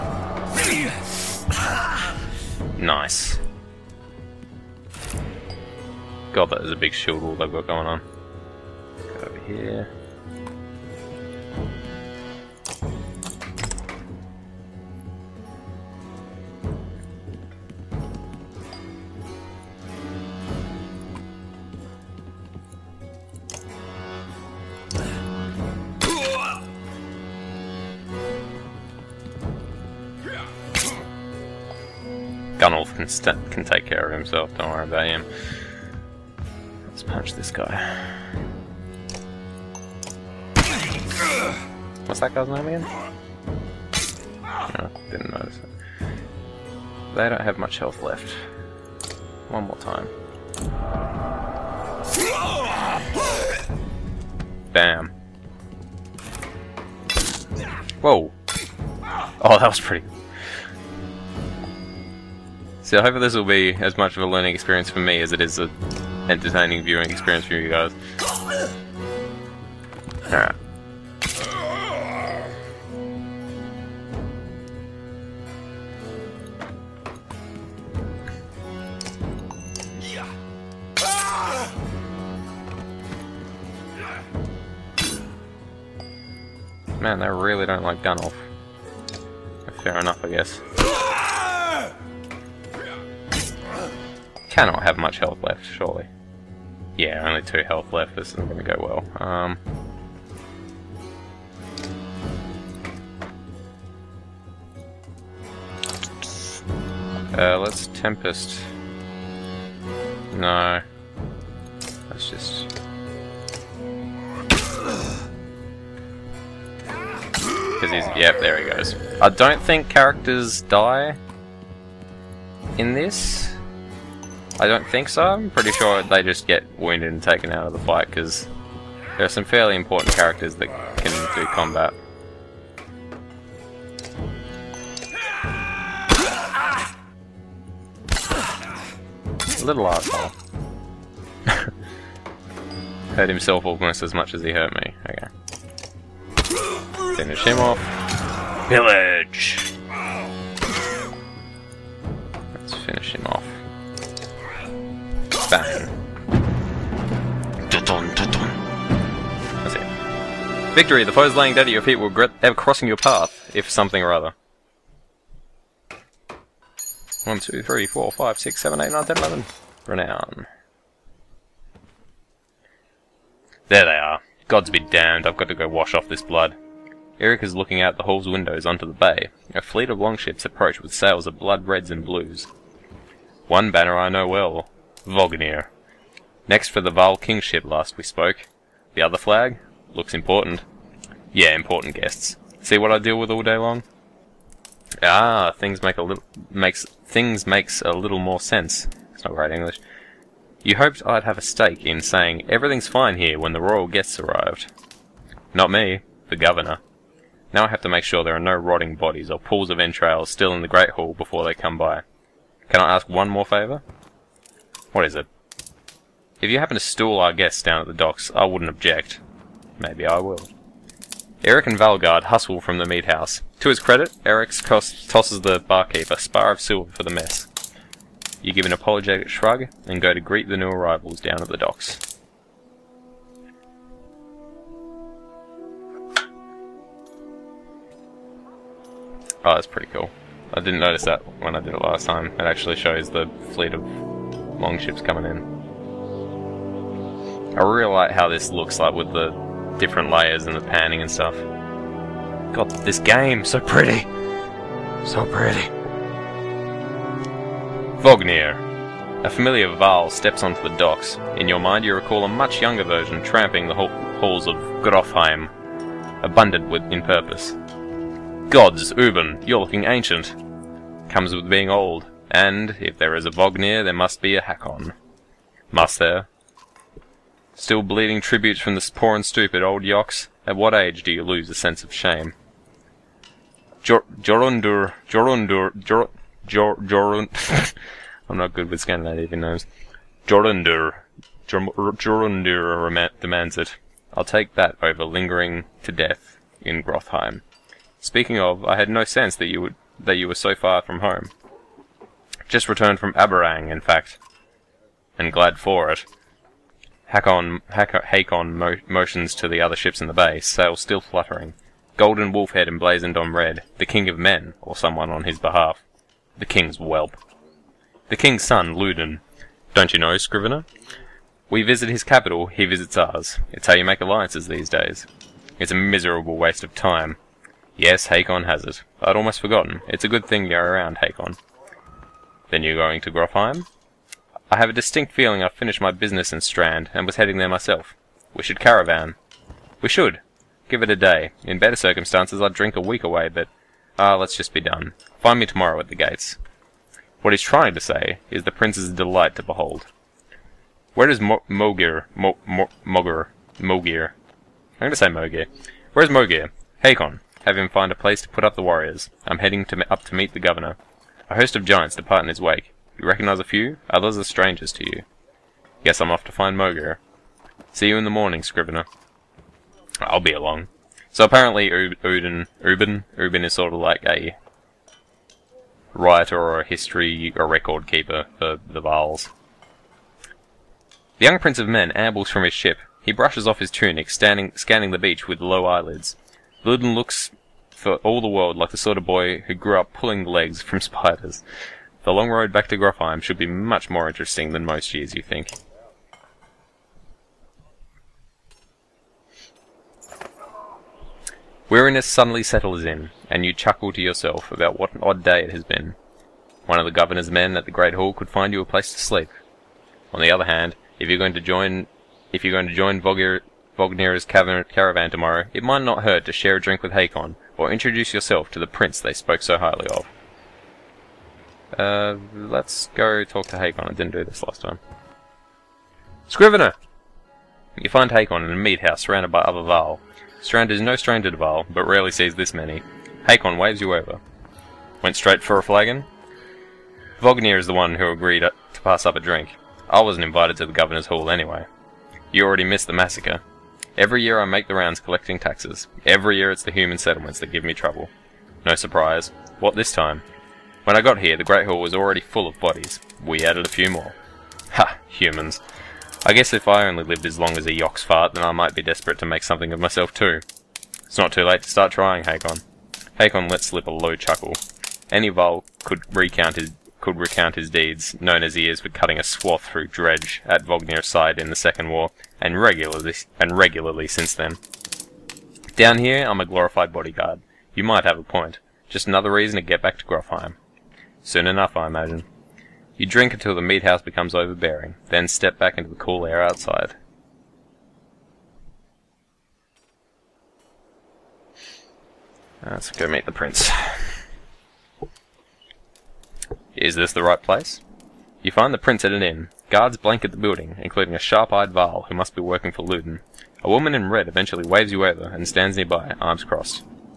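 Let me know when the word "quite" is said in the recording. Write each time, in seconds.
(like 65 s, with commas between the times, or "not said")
not said.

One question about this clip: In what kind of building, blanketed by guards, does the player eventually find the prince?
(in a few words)
An inn.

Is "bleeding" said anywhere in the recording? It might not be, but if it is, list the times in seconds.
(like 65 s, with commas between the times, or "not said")
277 s.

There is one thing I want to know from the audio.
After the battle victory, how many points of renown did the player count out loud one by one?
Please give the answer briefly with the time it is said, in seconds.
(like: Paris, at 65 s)
11, at 169 s.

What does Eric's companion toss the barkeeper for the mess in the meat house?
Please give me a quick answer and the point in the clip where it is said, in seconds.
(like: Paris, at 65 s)
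A spar of silver, at 226 s.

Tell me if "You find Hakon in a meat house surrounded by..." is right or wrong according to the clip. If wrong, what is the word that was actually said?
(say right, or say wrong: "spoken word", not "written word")
right.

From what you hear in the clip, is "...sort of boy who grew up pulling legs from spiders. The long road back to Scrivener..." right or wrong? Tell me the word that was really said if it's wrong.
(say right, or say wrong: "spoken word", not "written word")
wrong: "Grofheim", not "Scrivener".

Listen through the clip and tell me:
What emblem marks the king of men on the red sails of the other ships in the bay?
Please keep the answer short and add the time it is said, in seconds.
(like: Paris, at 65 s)
Golden wolf head, at 311 s.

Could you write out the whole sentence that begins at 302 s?
Just returned from Arberrang, in fact.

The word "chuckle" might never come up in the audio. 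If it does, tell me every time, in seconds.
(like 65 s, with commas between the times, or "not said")
403 s, 464 s.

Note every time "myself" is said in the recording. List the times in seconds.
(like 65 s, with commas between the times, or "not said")
337 s, 459 s.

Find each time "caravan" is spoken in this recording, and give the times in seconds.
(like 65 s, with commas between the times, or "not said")
338 s, 414 s.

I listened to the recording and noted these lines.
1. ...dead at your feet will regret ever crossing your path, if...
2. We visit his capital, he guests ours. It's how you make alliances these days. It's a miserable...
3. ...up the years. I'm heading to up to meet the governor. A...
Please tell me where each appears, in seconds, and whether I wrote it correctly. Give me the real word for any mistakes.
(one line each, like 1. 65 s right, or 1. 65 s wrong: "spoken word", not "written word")
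1. 161 s right
2. 321 s wrong: "visits", not "guests"
3. 358 s wrong: "warriors", not "years".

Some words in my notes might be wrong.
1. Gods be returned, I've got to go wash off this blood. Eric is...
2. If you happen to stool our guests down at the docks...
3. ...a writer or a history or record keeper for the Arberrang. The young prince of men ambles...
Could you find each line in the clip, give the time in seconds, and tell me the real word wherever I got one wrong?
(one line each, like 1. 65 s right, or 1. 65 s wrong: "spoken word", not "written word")
1. 174 s wrong: "damned", not "returned"
2. 216 s right
3. 374 s wrong: "Varls", not "Arberrang".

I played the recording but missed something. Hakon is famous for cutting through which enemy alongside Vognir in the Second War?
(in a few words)
Dredge.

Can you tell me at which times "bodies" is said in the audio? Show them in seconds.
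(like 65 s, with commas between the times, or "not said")
208 s, 452 s.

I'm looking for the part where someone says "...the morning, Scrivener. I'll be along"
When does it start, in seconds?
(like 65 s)
368 s.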